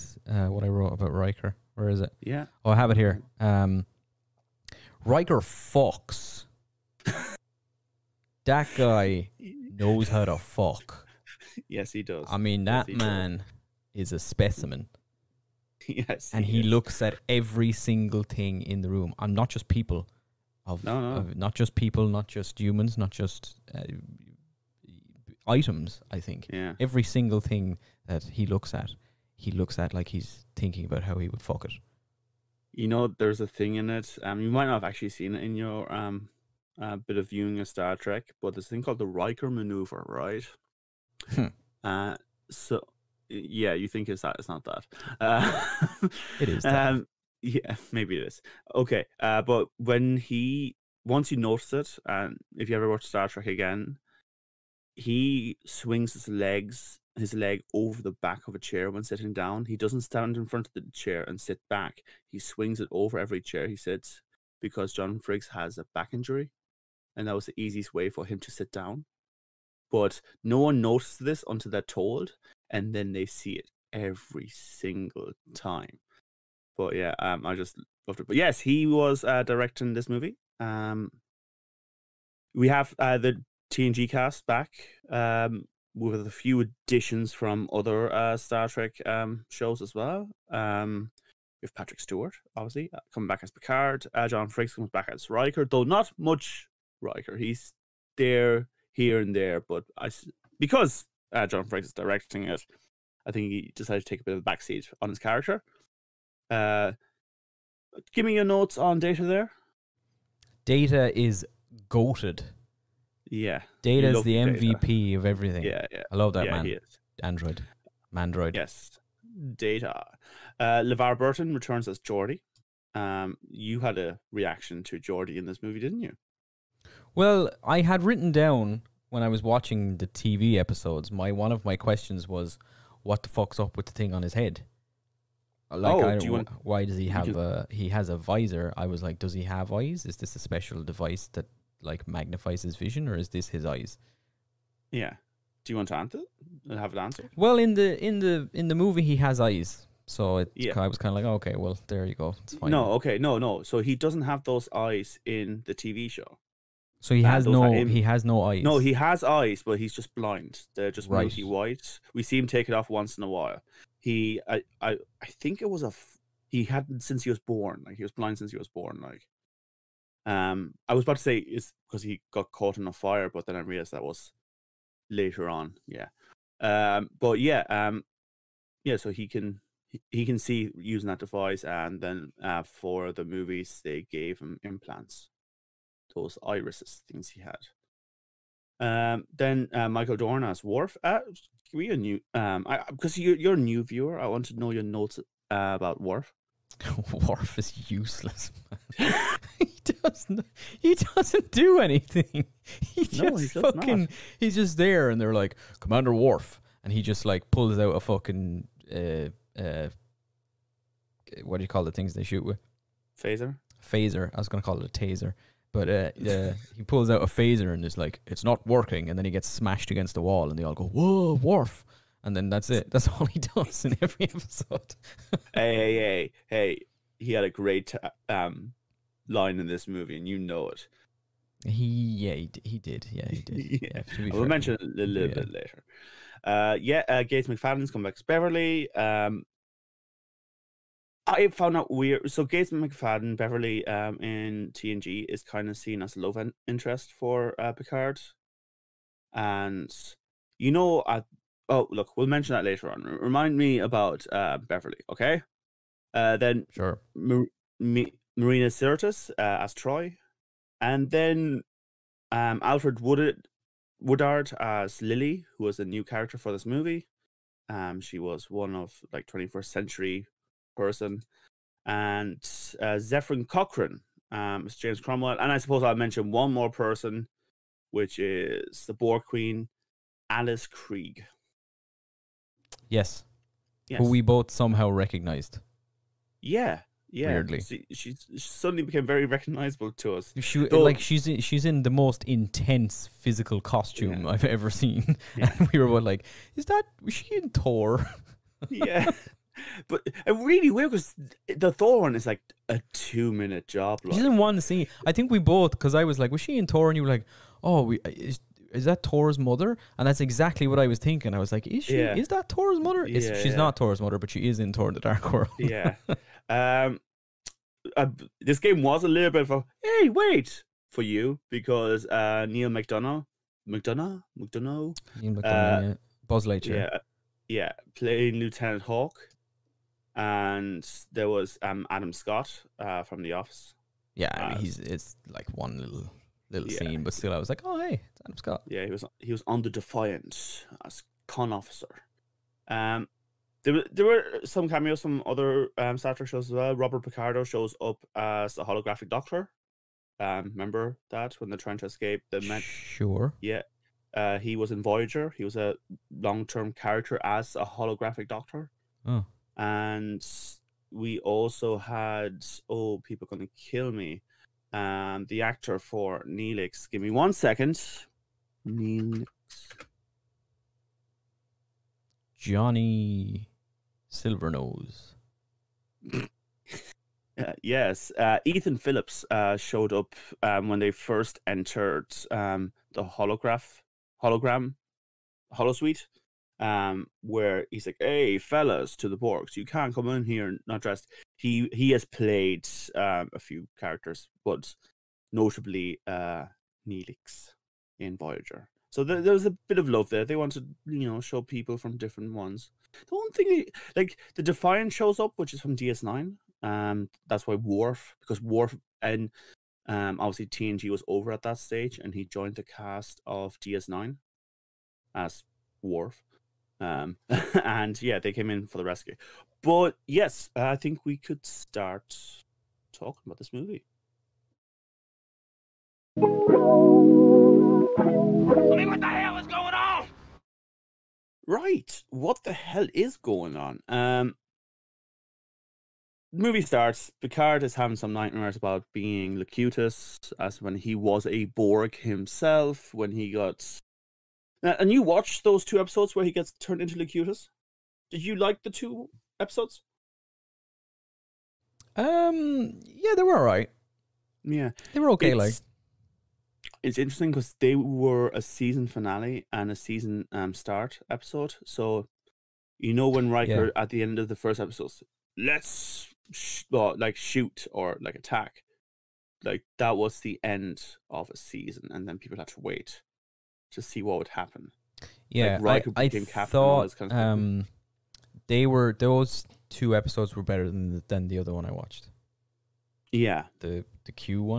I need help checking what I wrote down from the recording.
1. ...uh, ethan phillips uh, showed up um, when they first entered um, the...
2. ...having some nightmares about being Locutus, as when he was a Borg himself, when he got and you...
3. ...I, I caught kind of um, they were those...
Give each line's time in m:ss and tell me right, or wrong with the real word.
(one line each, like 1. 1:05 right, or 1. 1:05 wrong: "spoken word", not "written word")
1. 6:18 right
2. 7:17 right
3. 7:55 wrong: "thought", not "caught".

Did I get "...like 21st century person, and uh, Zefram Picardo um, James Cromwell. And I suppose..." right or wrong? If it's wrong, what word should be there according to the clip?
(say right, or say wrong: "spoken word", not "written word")
wrong: "Cochrane", not "Picardo".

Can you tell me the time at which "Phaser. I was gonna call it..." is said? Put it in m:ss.
3:33.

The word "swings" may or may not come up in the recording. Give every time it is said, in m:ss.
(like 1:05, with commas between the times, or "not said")
0:55, 1:02.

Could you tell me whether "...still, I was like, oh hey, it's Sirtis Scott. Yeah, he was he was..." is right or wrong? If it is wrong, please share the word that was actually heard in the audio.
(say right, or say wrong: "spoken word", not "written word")
wrong: "Adam", not "Sirtis".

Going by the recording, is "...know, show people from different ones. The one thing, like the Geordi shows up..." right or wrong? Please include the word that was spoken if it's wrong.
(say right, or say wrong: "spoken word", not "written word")
wrong: "Defiant", not "Geordi".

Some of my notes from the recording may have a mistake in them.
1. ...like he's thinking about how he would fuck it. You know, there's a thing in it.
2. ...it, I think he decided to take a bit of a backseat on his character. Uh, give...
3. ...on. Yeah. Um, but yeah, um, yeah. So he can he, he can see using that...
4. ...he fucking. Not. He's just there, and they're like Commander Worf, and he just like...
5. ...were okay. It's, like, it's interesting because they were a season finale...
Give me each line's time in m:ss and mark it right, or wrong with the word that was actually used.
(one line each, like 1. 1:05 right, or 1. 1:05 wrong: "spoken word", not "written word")
1. 0:29 right
2. 1:42 right
3. 2:55 right
4. 3:23 right
5. 7:34 right.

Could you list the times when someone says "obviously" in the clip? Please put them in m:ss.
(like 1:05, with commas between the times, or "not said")
1:32, 6:50.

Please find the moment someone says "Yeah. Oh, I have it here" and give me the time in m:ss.
0:02.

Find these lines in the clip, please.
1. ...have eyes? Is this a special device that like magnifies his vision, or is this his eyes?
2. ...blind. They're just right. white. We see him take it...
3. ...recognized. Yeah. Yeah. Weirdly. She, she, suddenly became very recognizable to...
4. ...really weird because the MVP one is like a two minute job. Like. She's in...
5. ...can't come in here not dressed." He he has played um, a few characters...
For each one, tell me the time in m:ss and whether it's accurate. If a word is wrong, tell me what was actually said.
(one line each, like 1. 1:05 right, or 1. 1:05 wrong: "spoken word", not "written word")
1. 2:19 right
2. 2:40 right
3. 4:44 right
4. 5:00 wrong: "Thor", not "MVP"
5. 6:29 right.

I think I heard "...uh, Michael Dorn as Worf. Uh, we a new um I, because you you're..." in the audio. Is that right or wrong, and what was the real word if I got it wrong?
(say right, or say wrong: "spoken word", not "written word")
right.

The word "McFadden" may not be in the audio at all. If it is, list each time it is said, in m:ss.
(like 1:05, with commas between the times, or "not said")
3:57, 4:02.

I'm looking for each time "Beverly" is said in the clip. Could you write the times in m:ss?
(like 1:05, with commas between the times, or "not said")
3:58, 4:03, 4:14.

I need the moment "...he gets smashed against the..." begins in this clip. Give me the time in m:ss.
3:39.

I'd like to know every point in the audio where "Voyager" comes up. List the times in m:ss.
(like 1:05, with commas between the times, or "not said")
5:54, 6:38.